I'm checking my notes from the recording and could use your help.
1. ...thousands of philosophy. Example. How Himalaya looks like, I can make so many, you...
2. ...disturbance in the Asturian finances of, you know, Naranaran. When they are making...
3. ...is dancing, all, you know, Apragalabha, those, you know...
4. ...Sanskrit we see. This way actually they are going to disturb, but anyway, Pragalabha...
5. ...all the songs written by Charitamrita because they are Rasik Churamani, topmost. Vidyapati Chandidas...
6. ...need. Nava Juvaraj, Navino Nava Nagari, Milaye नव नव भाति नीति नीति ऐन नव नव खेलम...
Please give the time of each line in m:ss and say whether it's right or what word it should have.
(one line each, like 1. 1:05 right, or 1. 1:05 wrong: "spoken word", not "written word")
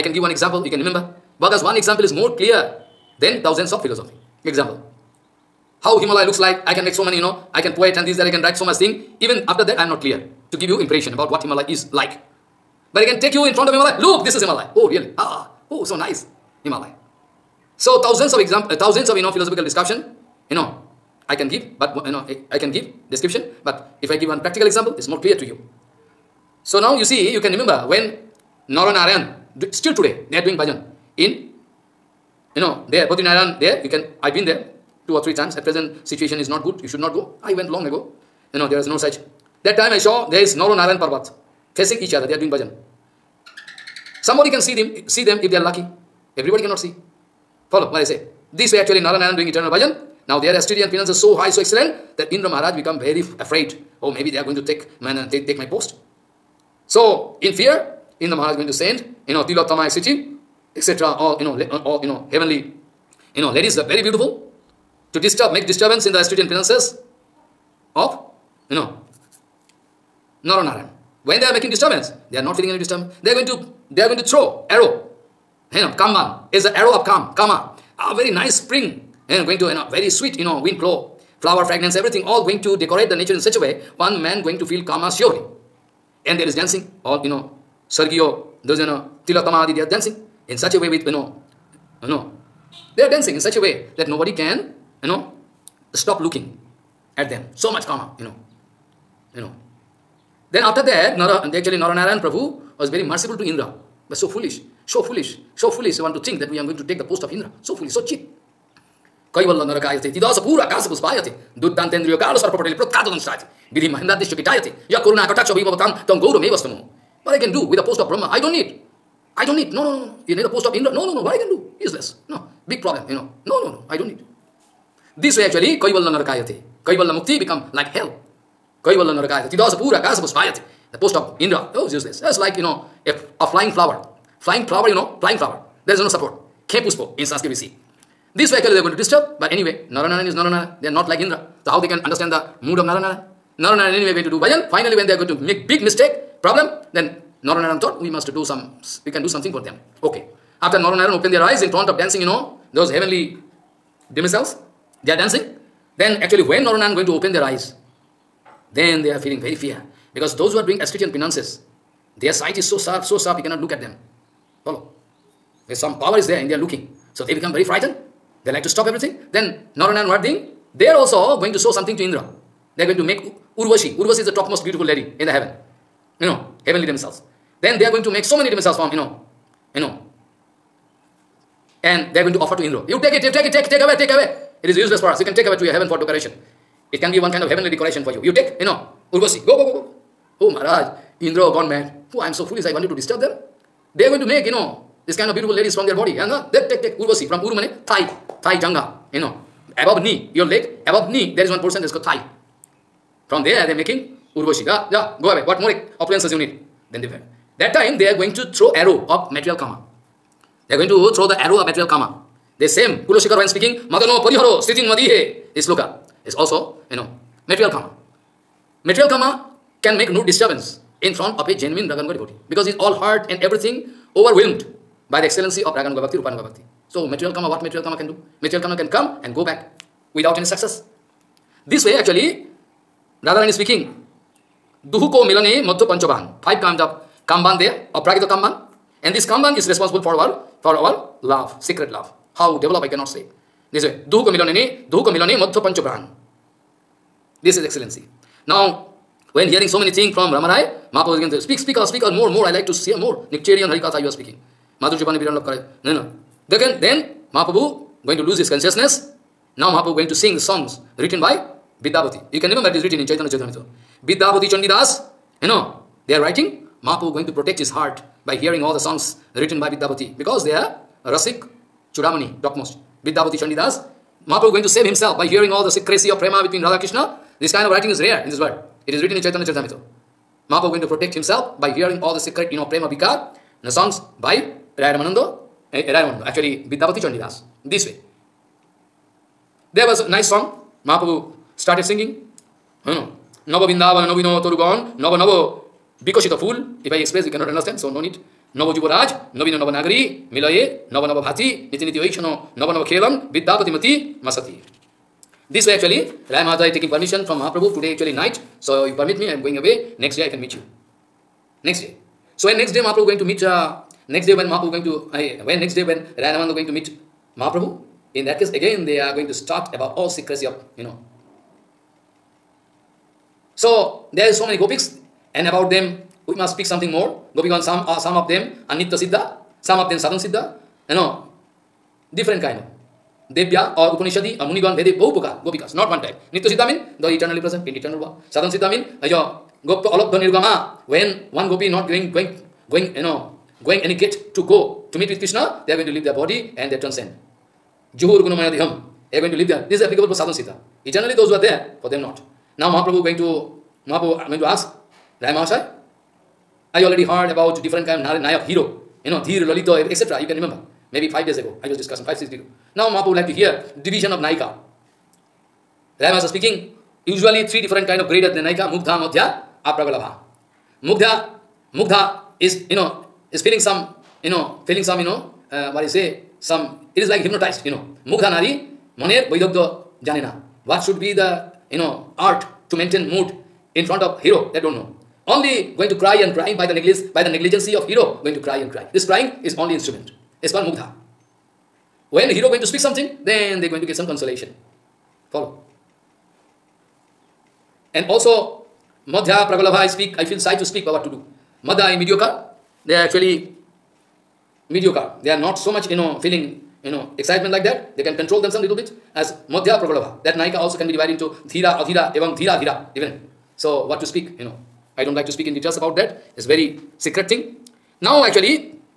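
1. 0:03 right
2. 1:05 right
3. 1:26 wrong: "Sergio", not "Apragalabha"
4. 2:17 wrong: "Naranaran", not "Pragalabha"
5. 4:28 wrong: "Vidyapati", not "Charitamrita"
6. 4:58 right.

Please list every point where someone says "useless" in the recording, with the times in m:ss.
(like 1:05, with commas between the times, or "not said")
2:01, 2:11, 3:04.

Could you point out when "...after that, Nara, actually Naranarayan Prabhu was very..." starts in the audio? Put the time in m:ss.
1:40.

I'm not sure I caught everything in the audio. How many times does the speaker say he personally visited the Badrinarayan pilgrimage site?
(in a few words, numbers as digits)
2 or 3.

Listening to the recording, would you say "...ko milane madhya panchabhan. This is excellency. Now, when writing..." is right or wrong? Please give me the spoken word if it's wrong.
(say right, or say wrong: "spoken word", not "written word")
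wrong: "hearing", not "writing".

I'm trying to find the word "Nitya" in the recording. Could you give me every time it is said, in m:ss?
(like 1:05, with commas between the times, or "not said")
5:28, 5:36.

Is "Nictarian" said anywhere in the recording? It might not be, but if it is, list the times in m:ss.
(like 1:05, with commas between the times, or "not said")
4:13.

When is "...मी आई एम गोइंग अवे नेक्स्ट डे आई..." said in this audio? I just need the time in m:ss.
5:09.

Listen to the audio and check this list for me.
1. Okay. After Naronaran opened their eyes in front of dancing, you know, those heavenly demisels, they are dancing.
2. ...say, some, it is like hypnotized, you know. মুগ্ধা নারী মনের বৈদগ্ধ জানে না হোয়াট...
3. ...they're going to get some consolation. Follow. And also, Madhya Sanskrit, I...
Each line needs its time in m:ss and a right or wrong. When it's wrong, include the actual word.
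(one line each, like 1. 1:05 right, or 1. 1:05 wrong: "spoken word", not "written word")
1. 2:30 right
2. 6:15 right
3. 6:33 wrong: "Pragalabha", not "Sanskrit".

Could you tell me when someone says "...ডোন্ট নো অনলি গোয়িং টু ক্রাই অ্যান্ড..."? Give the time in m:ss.
6:24.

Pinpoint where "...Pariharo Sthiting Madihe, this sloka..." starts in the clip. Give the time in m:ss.
3:34.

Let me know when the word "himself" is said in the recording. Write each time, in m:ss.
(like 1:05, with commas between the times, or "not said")
4:34, 4:41.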